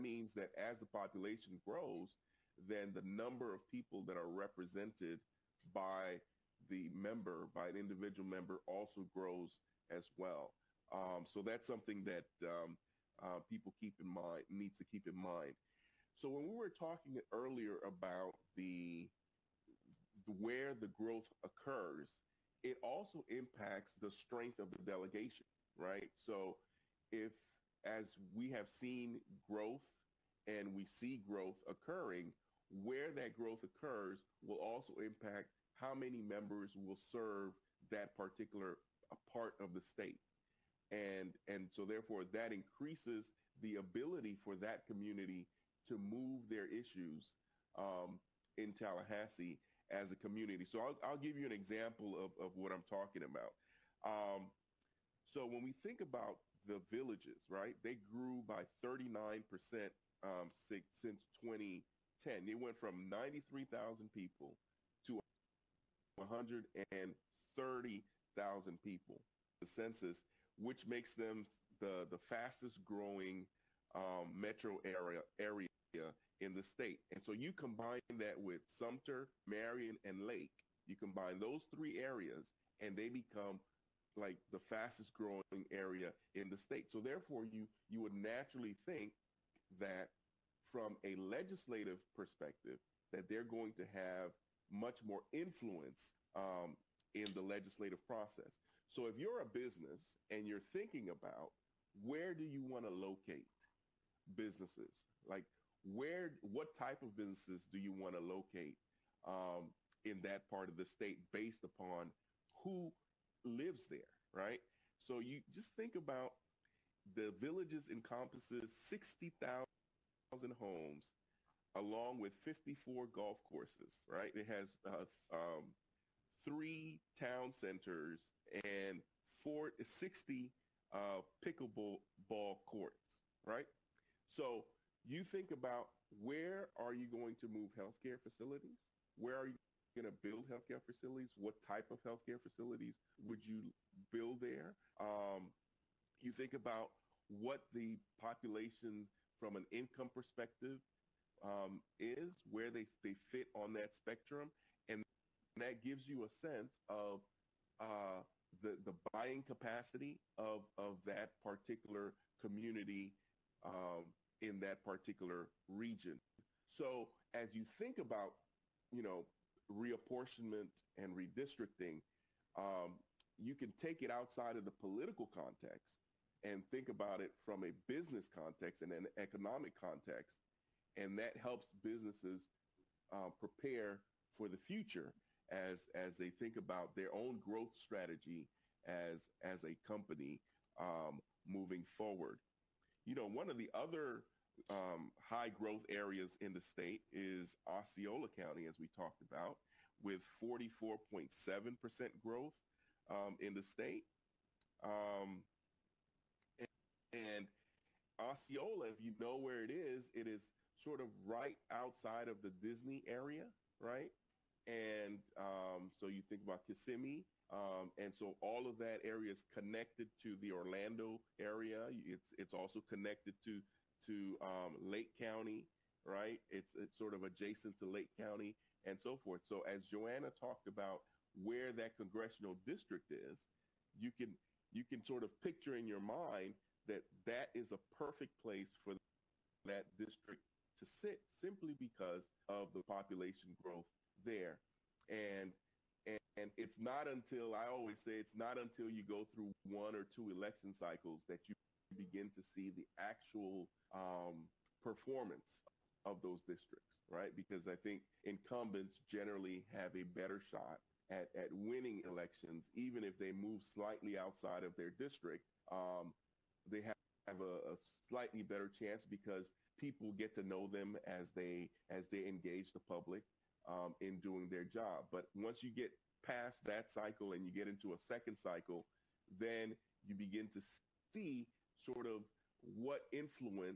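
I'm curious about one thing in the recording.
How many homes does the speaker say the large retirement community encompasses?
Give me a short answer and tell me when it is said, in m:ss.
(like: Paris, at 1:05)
60,000, at 1:58.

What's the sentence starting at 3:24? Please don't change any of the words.
Um, and, and Osceola, if you know where it is, it is sort of right outside of the Disney area, right?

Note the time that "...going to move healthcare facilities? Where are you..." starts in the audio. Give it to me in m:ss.
2:17.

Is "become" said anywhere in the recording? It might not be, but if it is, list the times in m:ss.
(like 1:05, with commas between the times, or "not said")
1:23.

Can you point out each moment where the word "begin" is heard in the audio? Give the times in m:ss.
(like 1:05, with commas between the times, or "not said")
4:11, 4:40.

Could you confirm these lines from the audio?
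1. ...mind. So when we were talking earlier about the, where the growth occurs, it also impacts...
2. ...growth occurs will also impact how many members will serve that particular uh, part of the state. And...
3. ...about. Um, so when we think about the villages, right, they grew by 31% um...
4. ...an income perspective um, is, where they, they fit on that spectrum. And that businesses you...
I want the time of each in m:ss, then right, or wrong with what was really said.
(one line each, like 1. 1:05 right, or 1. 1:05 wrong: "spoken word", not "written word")
1. 0:15 right
2. 0:33 right
3. 0:53 wrong: "39", not "31"
4. 2:29 wrong: "gives", not "businesses".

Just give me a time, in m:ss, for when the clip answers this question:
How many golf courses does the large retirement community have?
2:02.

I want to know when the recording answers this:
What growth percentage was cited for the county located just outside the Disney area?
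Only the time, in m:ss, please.
3:20.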